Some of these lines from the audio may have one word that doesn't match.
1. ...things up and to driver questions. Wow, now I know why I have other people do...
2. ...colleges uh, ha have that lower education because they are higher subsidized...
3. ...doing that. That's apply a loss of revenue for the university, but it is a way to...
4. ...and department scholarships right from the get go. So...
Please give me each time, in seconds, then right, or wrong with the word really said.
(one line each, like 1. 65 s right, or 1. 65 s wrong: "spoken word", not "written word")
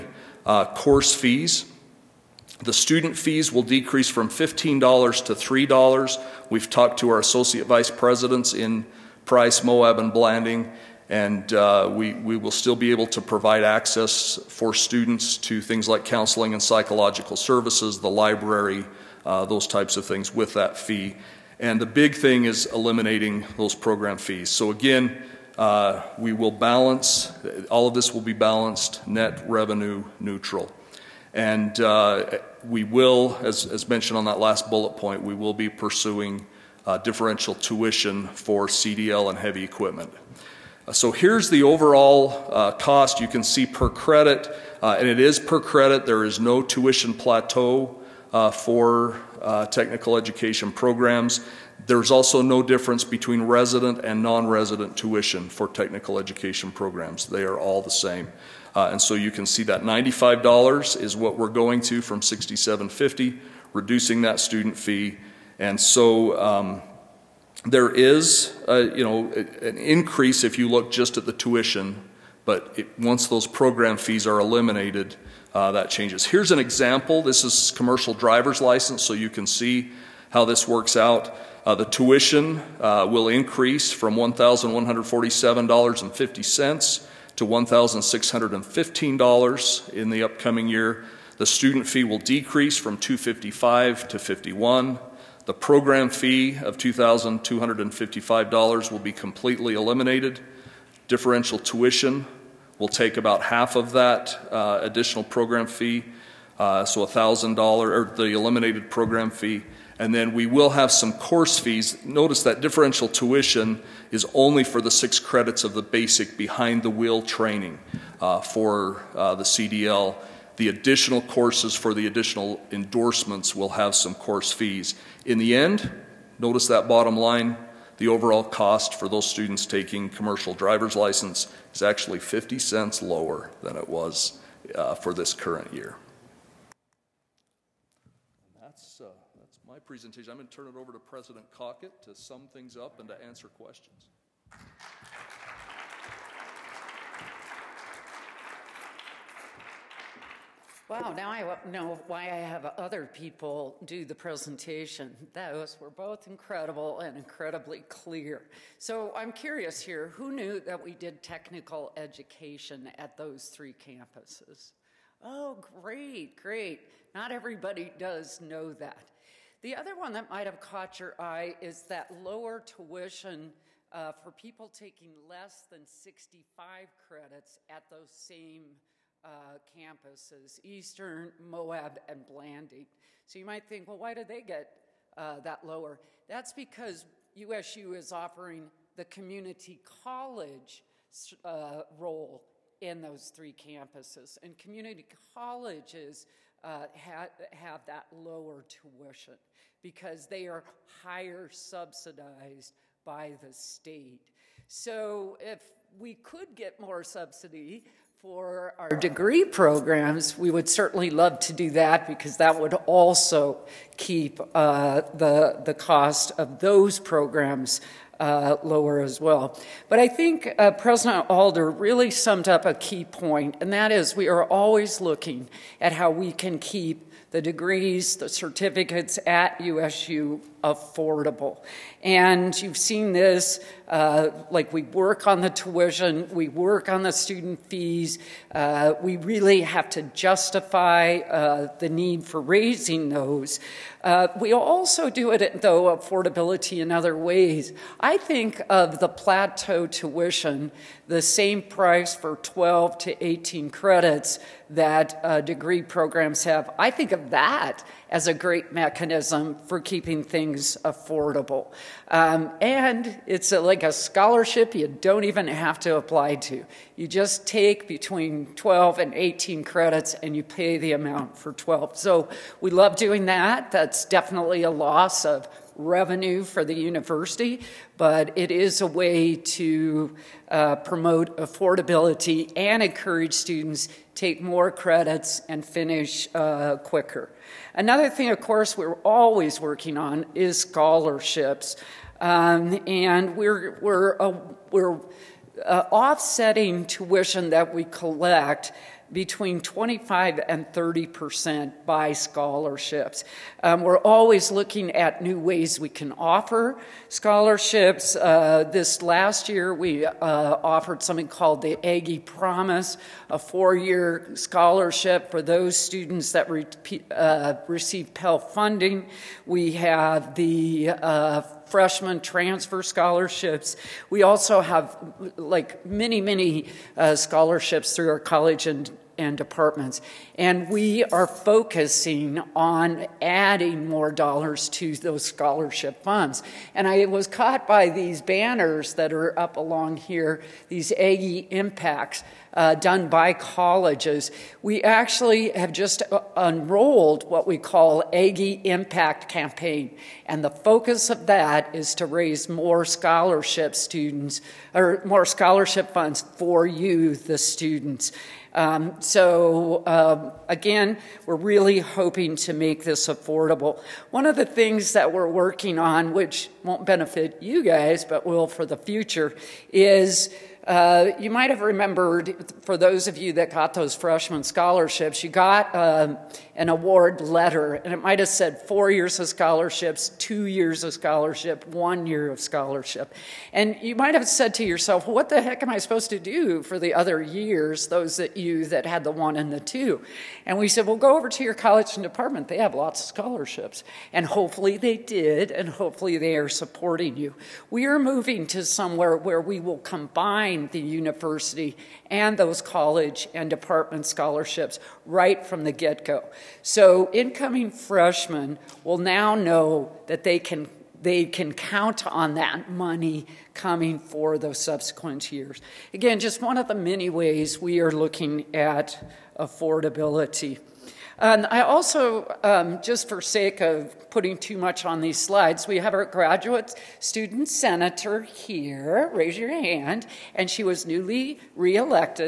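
1. 142 s wrong: "answer", not "driver"
2. 195 s wrong: "tuition", not "education"
3. 272 s wrong: "definitely", not "apply"
4. 403 s right.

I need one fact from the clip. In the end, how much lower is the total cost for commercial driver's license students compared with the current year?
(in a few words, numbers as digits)
50 cents.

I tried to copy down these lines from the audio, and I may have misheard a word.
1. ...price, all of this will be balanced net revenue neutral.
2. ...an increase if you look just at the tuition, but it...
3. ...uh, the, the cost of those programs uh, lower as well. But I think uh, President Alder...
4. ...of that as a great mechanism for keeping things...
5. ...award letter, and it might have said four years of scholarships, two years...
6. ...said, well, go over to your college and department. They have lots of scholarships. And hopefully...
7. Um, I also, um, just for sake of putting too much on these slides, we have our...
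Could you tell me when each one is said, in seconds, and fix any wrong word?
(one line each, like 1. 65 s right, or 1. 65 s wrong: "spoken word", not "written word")
1. 26 s wrong: "balance", not "price"
2. 69 s right
3. 214 s right
4. 257 s right
5. 376 s right
6. 390 s right
7. 421 s right.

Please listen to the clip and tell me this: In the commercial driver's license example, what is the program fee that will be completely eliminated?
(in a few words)
$2,255.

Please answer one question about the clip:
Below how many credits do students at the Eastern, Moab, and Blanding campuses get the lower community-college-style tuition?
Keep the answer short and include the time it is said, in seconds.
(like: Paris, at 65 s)
65 credits, at 175 s.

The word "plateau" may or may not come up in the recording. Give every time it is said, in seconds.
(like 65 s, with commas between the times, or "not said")
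47 s, 249 s.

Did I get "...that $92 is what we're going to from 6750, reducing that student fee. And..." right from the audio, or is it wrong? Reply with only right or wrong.
wrong.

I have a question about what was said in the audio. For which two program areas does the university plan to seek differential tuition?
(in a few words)
CDL and heavy equipment.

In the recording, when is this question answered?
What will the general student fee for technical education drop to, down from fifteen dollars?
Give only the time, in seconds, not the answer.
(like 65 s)
5 s.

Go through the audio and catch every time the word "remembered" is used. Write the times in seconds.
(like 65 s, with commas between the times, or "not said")
371 s.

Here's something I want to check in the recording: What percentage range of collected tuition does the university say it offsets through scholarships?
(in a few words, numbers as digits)
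25 to 30 percent.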